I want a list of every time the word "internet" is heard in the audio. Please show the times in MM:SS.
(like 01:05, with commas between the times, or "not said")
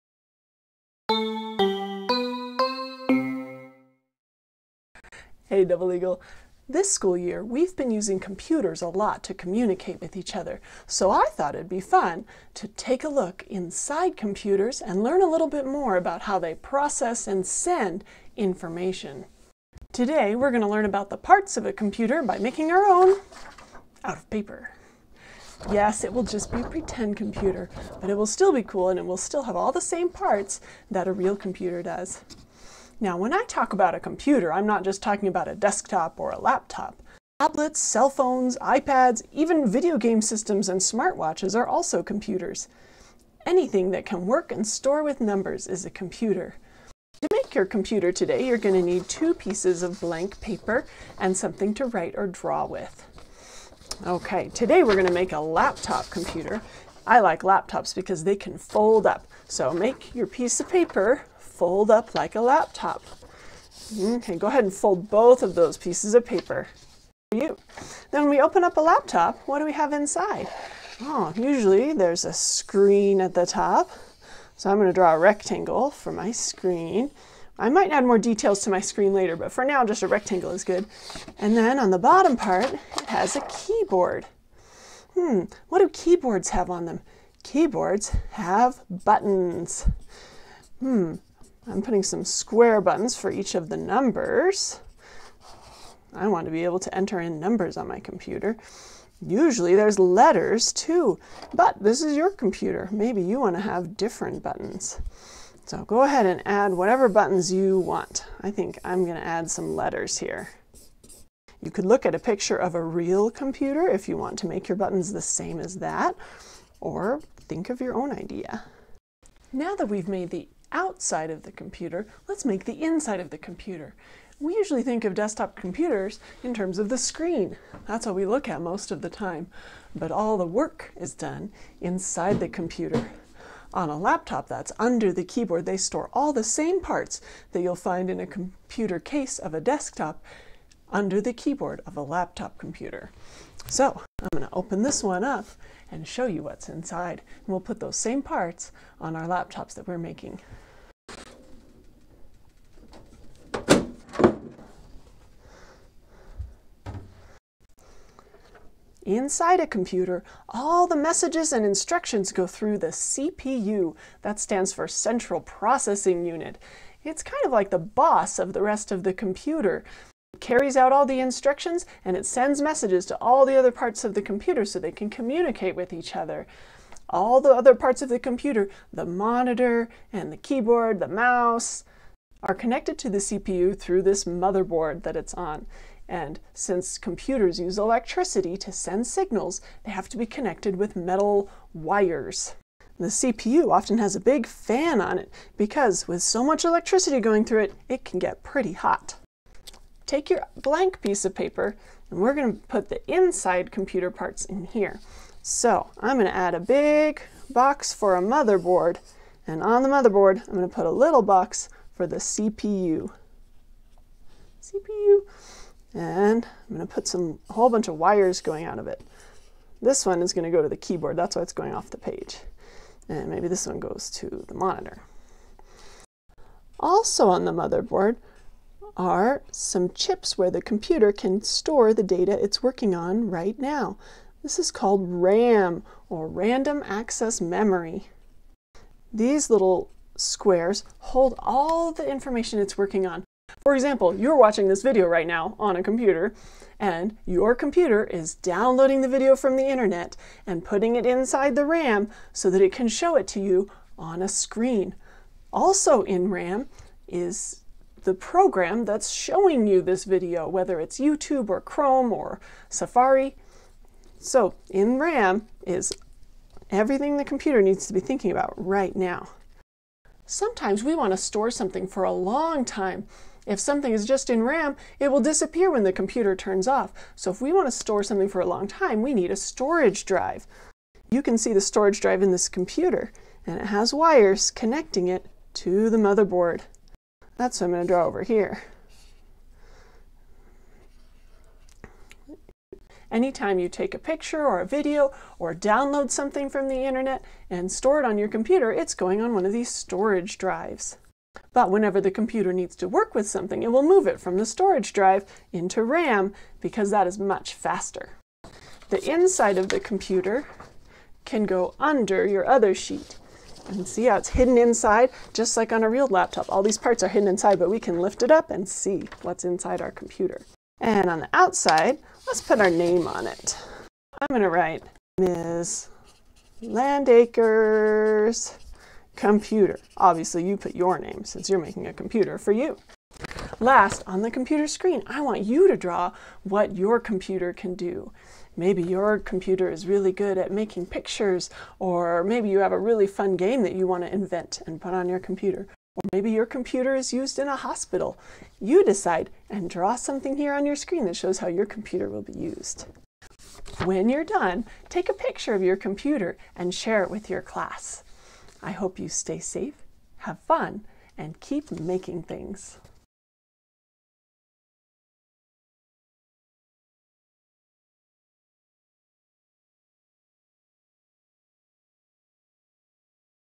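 04:09, 04:56.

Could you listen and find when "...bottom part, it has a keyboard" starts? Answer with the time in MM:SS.
01:21.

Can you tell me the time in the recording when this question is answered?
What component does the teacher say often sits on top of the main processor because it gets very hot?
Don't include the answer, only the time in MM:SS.
03:14.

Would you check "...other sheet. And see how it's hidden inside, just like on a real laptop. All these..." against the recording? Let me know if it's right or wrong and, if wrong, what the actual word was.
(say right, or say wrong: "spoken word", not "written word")
right.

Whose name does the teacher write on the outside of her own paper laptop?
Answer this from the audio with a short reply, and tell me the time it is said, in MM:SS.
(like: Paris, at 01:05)
Ms. Landaker, at 05:25.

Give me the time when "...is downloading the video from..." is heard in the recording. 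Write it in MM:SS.
04:08.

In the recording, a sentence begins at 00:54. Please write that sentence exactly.
Okay, today we're going to make a laptop computer.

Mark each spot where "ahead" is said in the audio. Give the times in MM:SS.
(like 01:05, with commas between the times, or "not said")
01:04, 01:46.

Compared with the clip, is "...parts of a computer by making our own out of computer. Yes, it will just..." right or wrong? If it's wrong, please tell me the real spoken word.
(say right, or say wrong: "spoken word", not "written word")
wrong: "paper", not "computer".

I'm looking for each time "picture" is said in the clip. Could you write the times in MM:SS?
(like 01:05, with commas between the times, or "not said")
01:52, 04:53, 05:40, 05:55.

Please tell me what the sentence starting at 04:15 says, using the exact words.
Also in RAM is the program that's showing you this video, whether it's YouTube or Chrome or Safari.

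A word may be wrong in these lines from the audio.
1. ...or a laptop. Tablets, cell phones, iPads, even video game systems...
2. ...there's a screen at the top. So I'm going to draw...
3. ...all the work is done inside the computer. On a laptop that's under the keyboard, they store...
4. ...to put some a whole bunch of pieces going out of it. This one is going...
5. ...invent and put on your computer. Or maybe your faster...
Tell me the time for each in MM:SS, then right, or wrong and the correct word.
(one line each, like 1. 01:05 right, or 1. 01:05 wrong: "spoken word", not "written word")
1. 00:36 right
2. 01:11 right
3. 02:10 right
4. 03:36 wrong: "wires", not "pieces"
5. 05:44 wrong: "computer", not "faster".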